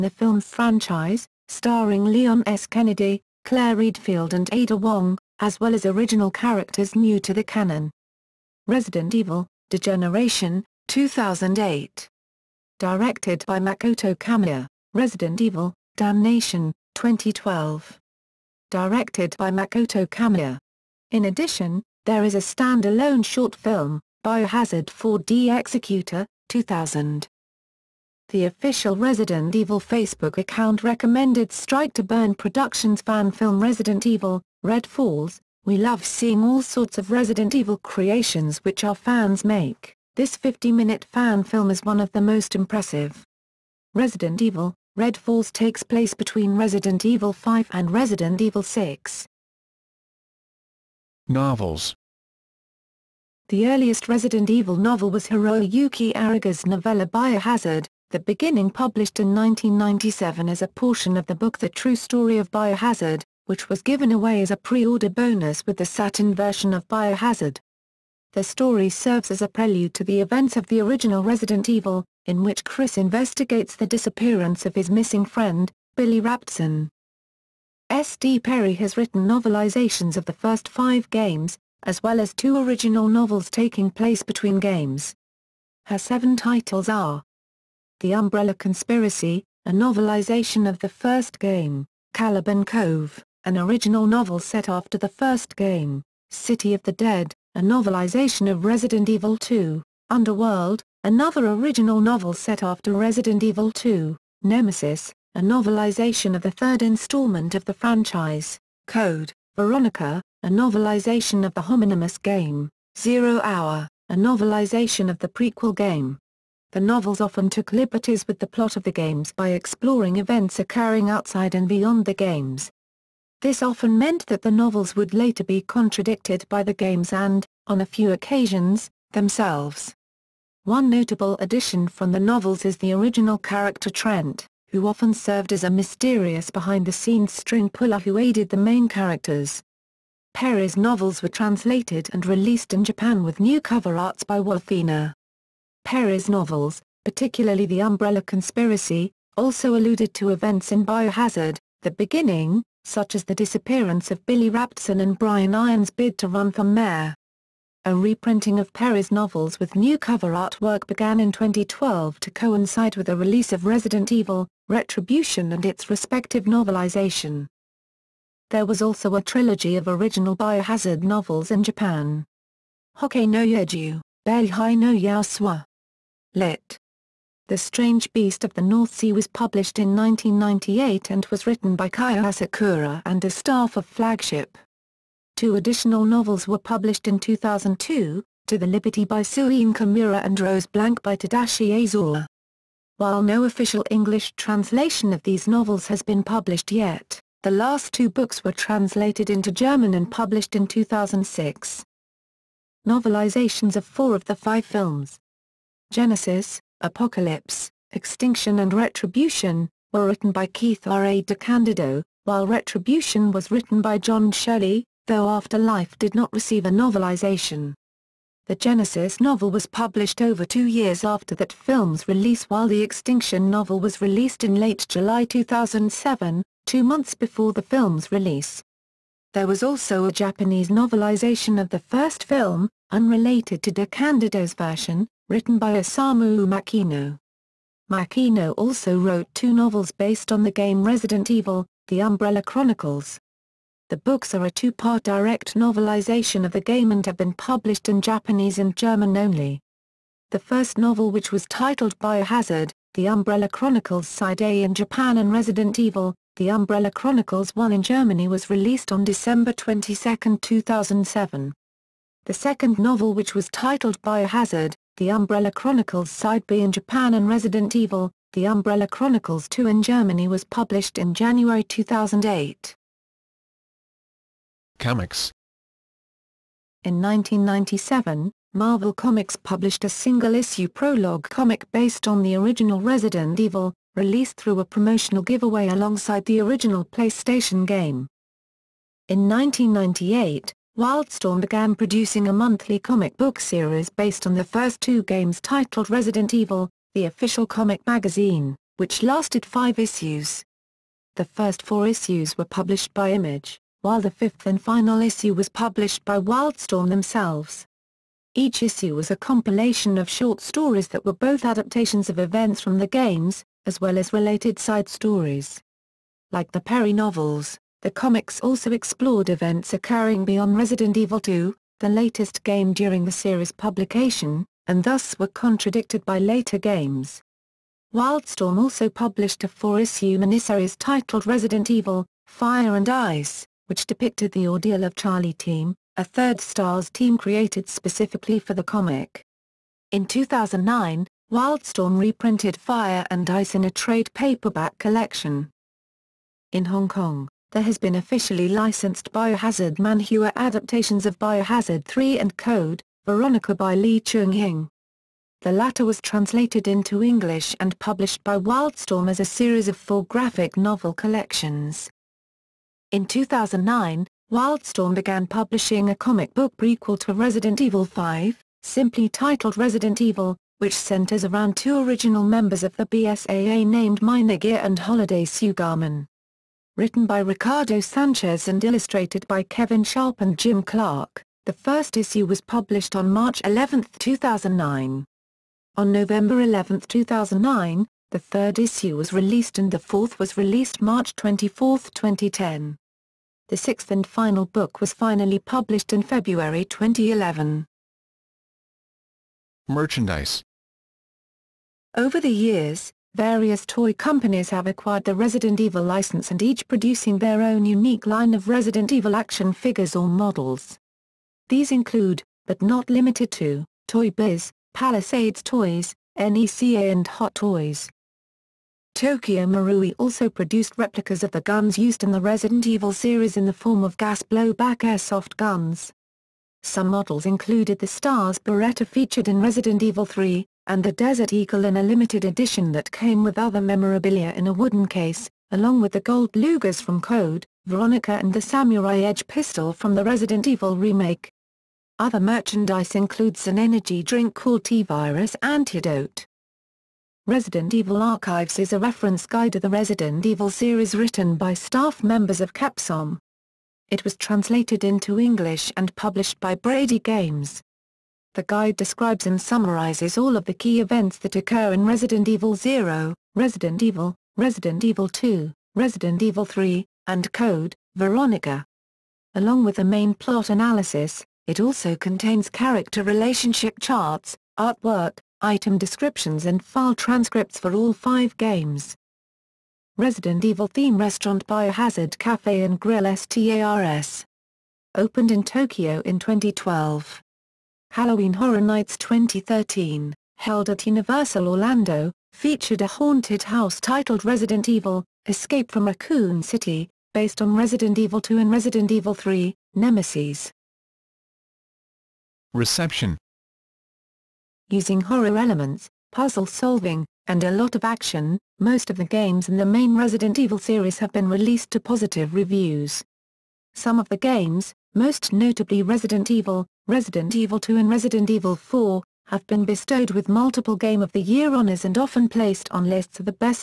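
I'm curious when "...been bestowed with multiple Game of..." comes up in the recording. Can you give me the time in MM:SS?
08:39.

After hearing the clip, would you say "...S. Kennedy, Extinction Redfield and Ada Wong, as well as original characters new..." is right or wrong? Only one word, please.
wrong.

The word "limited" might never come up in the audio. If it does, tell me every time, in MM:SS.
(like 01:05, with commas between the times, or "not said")
06:52, 07:11.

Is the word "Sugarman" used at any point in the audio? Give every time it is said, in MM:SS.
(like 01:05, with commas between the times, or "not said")
06:15.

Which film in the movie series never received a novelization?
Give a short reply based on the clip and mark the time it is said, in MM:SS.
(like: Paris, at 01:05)
Afterlife, at 03:35.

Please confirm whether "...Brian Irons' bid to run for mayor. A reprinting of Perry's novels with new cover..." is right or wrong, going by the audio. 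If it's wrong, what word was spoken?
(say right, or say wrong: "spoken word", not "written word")
right.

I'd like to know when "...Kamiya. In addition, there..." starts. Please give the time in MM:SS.
00:20.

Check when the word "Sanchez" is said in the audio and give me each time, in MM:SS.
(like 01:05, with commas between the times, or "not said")
06:17.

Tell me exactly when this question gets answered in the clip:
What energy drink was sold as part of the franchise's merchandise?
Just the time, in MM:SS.
07:24.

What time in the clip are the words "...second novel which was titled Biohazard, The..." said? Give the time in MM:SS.
04:22.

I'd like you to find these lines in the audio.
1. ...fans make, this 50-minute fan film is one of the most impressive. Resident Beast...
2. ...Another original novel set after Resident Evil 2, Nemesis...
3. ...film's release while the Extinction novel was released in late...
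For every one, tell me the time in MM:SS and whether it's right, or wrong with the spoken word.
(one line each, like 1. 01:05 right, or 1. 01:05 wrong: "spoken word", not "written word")
1. 00:38 wrong: "Evil", not "Beast"
2. 01:41 right
3. 03:41 right.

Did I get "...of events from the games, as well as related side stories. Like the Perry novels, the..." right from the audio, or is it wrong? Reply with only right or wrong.
right.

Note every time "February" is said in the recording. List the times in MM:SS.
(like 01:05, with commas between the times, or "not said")
06:36.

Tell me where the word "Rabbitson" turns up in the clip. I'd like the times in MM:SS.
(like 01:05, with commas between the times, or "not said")
01:16, 02:34.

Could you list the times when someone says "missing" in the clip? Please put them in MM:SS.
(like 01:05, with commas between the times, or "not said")
01:14.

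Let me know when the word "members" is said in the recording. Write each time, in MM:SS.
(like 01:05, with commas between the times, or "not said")
06:12, 07:32.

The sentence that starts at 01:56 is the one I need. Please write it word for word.
The novels often took liberties with the plot of the games by exploring events occurring outside and beyond the games.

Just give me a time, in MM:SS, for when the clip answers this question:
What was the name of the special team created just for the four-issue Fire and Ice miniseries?
05:34.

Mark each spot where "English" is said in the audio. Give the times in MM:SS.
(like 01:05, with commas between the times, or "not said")
03:13, 05:57, 07:35.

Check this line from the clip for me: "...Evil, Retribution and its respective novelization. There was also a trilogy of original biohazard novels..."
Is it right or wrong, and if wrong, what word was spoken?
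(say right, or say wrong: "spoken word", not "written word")
right.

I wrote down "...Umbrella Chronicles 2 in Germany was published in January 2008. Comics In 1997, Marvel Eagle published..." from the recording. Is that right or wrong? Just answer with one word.
wrong.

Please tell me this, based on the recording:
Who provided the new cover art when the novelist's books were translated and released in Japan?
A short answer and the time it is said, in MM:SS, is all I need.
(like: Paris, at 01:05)
Wolfina, at 02:24.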